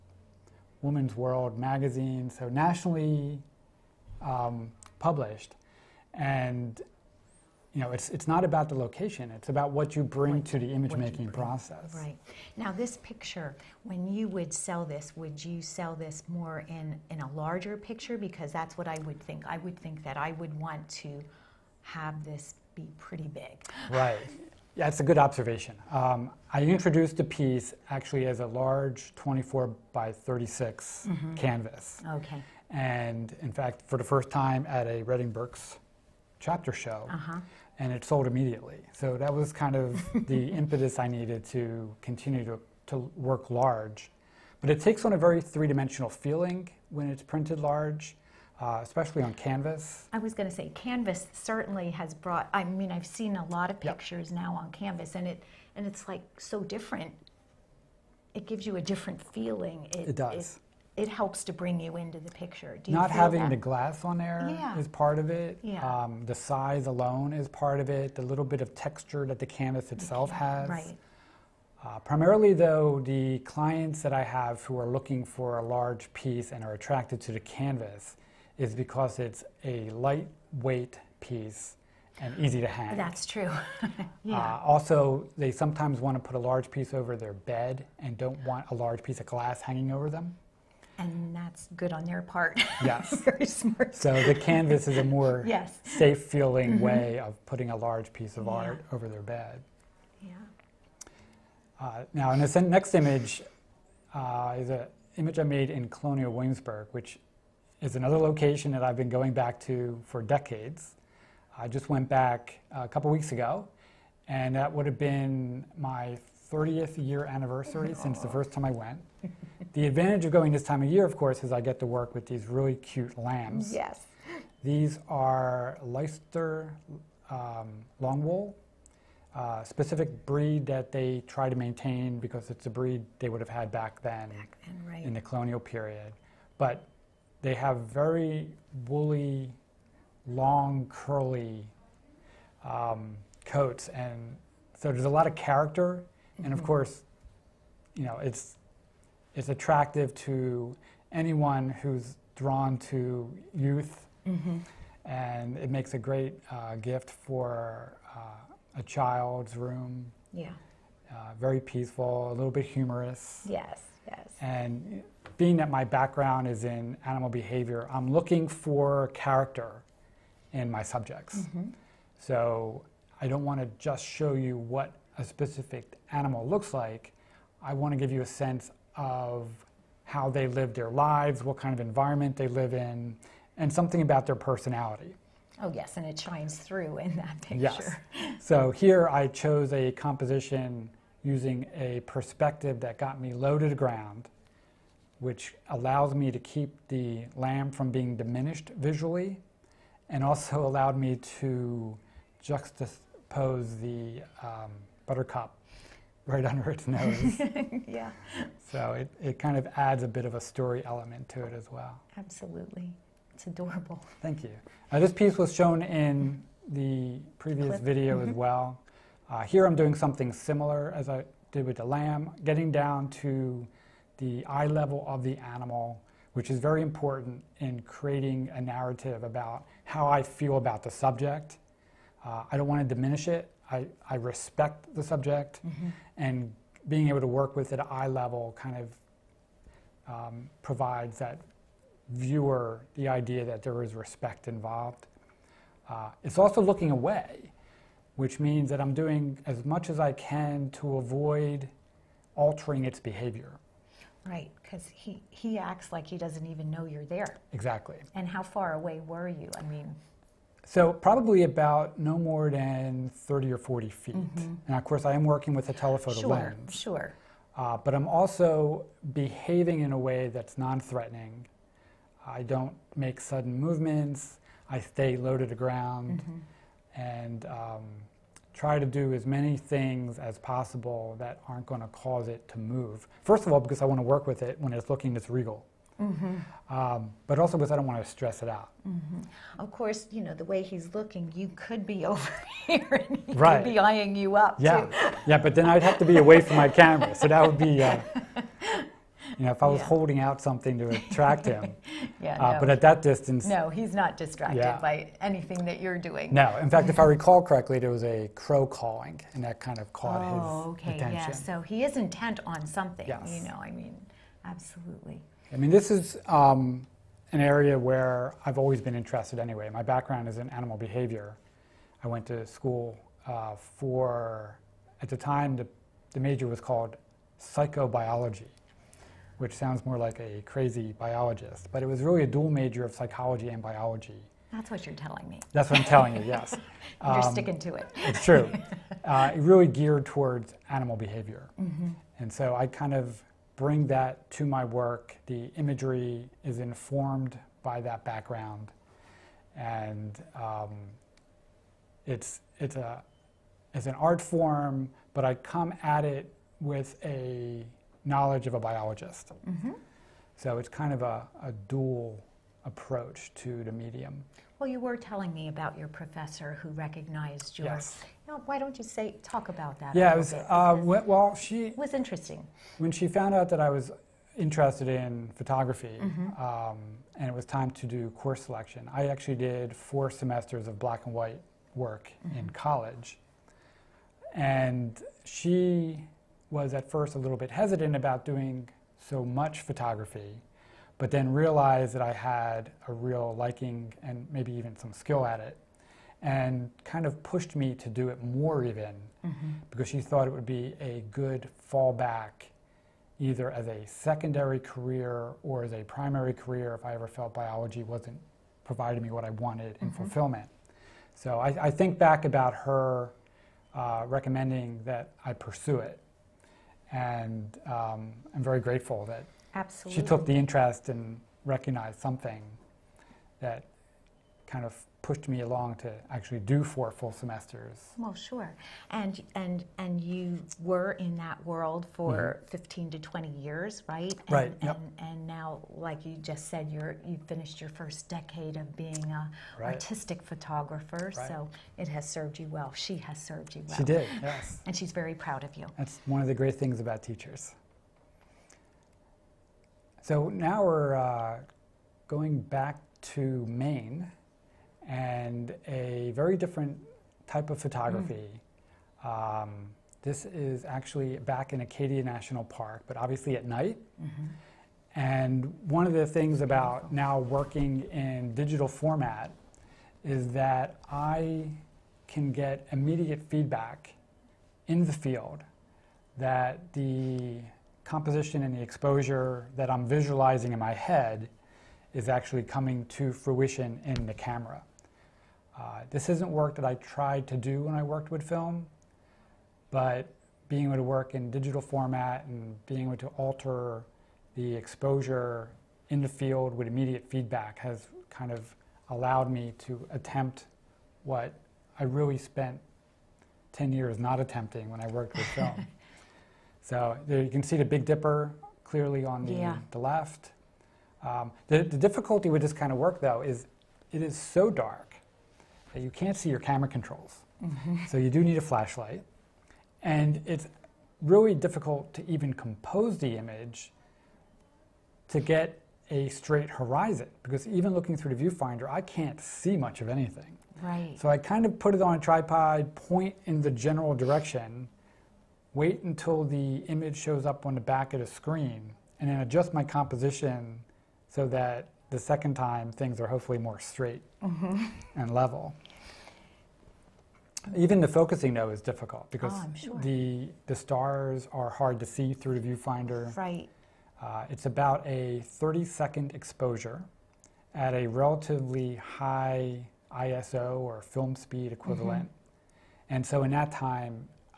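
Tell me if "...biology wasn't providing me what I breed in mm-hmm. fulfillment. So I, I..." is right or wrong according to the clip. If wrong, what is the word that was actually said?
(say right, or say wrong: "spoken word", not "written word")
wrong: "wanted", not "breed".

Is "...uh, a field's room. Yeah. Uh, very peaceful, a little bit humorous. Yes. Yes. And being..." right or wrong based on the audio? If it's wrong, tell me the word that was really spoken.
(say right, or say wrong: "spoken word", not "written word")
wrong: "child", not "field".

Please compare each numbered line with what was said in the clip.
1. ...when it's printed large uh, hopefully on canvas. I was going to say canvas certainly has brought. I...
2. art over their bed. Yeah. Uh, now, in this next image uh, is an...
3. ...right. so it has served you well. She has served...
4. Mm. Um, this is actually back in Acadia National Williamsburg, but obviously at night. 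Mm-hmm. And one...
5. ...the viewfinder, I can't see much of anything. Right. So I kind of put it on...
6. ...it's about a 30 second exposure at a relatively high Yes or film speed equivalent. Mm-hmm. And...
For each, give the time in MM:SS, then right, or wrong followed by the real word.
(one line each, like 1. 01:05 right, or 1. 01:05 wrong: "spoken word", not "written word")
1. 00:46 wrong: "especially", not "hopefully"
2. 01:38 right
3. 07:21 right
4. 07:39 wrong: "Park", not "Williamsburg"
5. 08:48 right
6. 09:14 wrong: "ISO", not "Yes".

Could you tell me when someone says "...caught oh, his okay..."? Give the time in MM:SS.
05:09.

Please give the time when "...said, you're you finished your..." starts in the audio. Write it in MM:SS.
07:16.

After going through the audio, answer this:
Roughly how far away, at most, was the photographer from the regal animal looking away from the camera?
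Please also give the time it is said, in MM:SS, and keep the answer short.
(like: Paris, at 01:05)
30 or 40 feet, at 04:23.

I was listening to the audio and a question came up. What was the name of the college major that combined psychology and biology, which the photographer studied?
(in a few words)
Psychobiology.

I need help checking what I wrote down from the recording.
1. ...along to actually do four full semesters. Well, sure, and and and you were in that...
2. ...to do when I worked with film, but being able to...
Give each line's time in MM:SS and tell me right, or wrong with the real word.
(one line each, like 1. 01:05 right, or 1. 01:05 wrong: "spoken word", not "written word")
1. 07:05 right
2. 08:07 right.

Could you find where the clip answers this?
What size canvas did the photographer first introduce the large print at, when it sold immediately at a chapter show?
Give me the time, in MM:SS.
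00:29.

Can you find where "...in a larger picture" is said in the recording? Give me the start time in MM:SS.
00:17.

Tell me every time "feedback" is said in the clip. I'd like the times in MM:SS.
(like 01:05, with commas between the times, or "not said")
07:53, 08:17.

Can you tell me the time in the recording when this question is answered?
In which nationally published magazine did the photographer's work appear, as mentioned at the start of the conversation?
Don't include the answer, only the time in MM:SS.
00:00.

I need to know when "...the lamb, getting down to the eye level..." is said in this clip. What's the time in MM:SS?
03:41.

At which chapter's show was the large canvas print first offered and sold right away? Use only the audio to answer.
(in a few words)
Reading Berks.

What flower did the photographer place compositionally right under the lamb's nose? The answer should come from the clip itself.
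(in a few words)
Buttercup.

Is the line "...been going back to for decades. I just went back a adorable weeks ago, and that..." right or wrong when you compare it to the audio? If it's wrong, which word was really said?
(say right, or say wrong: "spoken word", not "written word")
wrong: "couple", not "adorable".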